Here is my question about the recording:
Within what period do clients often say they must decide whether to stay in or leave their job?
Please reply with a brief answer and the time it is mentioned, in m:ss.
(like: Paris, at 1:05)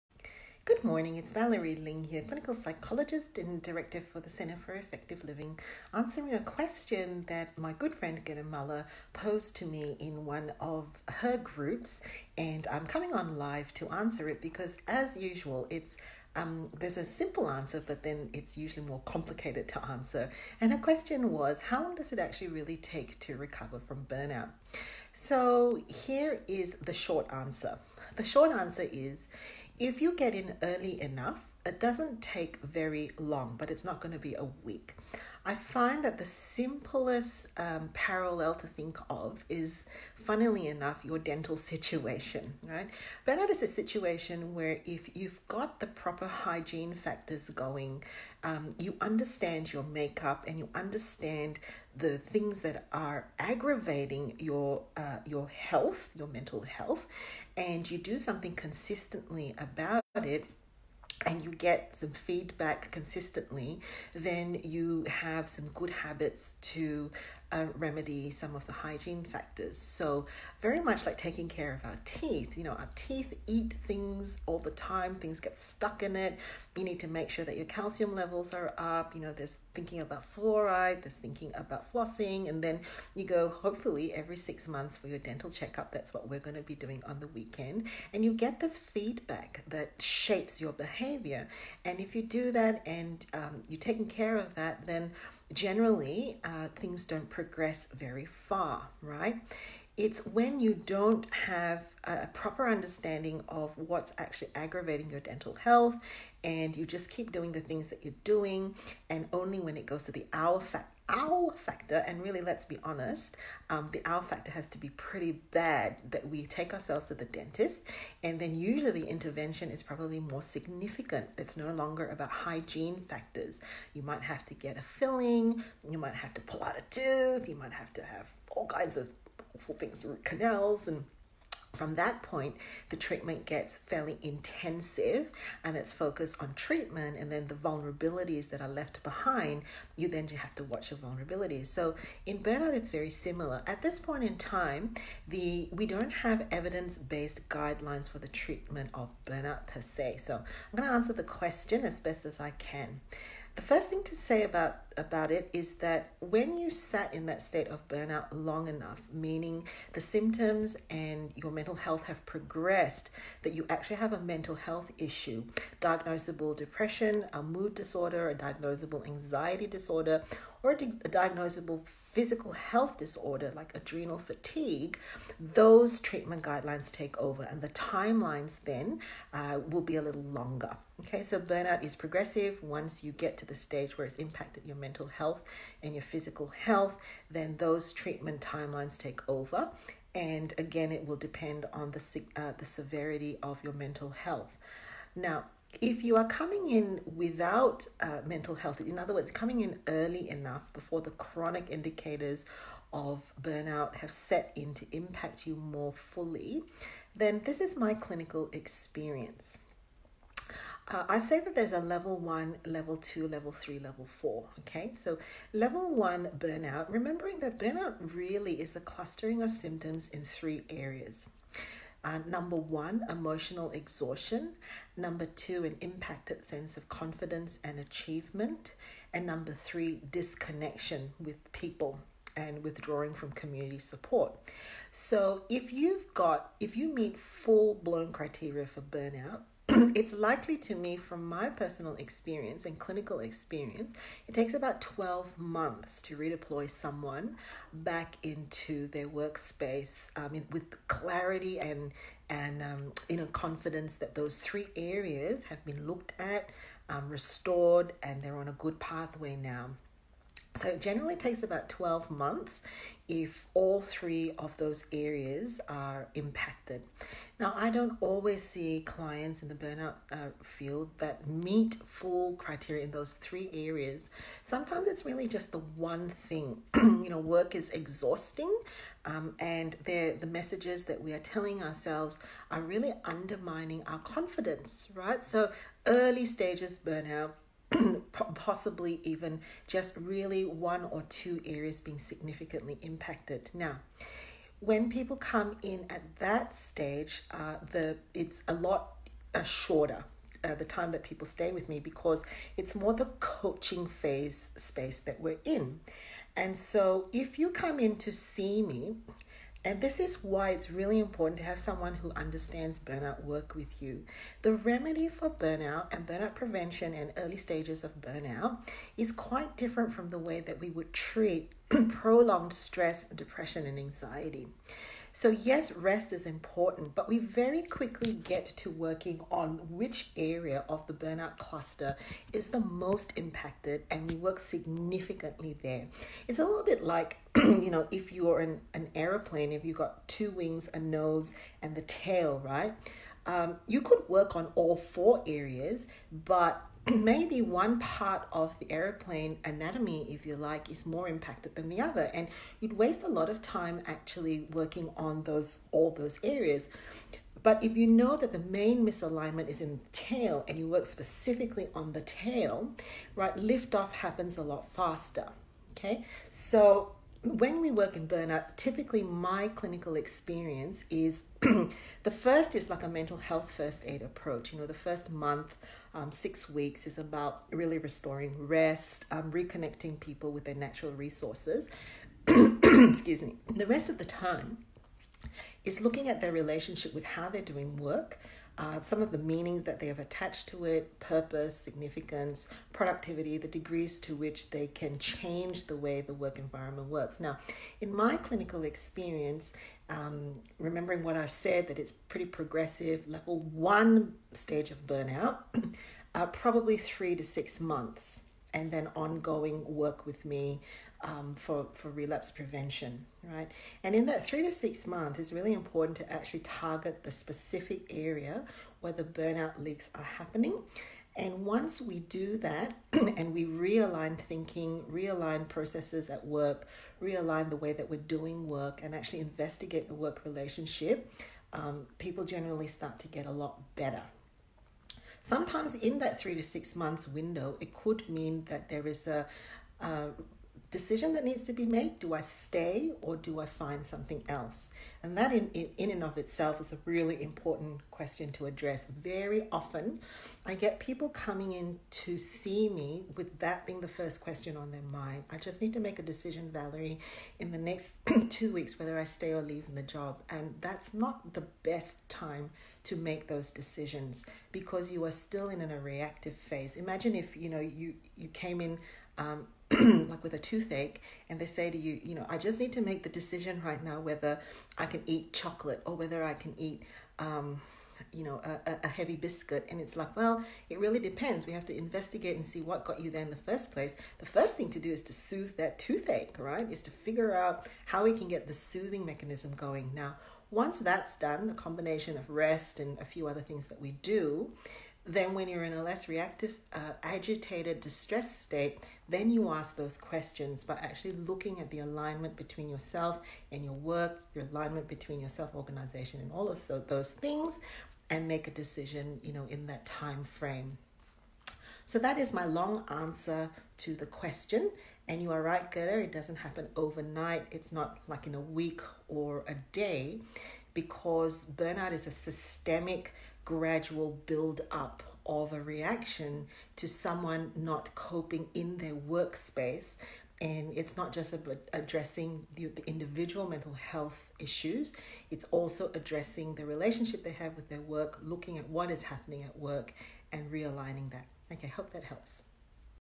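2 weeks, at 7:38.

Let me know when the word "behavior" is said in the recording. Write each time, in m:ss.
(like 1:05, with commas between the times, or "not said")
1:30.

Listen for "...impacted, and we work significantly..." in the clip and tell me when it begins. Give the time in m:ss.
5:33.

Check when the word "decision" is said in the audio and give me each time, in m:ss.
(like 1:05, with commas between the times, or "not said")
7:20, 7:36, 7:43, 7:53, 8:28.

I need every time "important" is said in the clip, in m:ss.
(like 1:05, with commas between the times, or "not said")
5:10, 5:26, 6:55, 7:27.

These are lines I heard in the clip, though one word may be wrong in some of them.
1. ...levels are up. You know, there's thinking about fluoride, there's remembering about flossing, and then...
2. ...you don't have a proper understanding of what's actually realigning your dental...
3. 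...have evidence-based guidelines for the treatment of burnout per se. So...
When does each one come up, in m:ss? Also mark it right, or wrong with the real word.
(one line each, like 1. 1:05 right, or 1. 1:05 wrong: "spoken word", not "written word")
1. 1:18 wrong: "thinking", not "remembering"
2. 1:40 wrong: "aggravating", not "realigning"
3. 2:26 right.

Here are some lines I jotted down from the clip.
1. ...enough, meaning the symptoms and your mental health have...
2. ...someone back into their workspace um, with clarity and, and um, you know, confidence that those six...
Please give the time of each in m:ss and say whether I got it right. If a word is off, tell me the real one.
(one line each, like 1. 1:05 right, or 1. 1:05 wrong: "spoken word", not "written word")
1. 2:38 right
2. 4:06 wrong: "three", not "six".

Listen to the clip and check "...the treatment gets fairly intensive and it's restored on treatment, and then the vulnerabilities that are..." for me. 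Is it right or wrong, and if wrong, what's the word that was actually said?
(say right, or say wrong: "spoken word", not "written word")
wrong: "focused", not "restored".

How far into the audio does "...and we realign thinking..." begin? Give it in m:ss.
7:02.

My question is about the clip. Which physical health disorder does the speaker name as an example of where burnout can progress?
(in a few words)
adrenal fatigue.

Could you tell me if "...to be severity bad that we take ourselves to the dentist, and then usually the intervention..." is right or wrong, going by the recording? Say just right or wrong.
wrong.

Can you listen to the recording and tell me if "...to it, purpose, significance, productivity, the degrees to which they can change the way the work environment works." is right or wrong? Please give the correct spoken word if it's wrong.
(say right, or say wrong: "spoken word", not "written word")
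right.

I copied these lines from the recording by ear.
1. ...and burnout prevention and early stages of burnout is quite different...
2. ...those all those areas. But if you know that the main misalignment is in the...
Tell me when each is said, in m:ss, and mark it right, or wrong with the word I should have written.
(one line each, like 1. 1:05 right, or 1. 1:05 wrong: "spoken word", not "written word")
1. 5:15 right
2. 5:55 right.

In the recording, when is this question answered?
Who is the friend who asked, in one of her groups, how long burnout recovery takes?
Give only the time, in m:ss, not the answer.
0:08.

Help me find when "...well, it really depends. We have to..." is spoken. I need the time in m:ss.
8:00.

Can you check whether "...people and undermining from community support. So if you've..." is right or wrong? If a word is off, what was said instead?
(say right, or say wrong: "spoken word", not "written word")
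wrong: "withdrawing", not "undermining".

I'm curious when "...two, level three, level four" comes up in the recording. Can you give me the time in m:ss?
3:32.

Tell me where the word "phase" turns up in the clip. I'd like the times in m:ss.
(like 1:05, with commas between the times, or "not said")
5:03, 7:46.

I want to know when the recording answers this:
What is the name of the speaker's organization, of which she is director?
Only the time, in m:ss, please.
0:04.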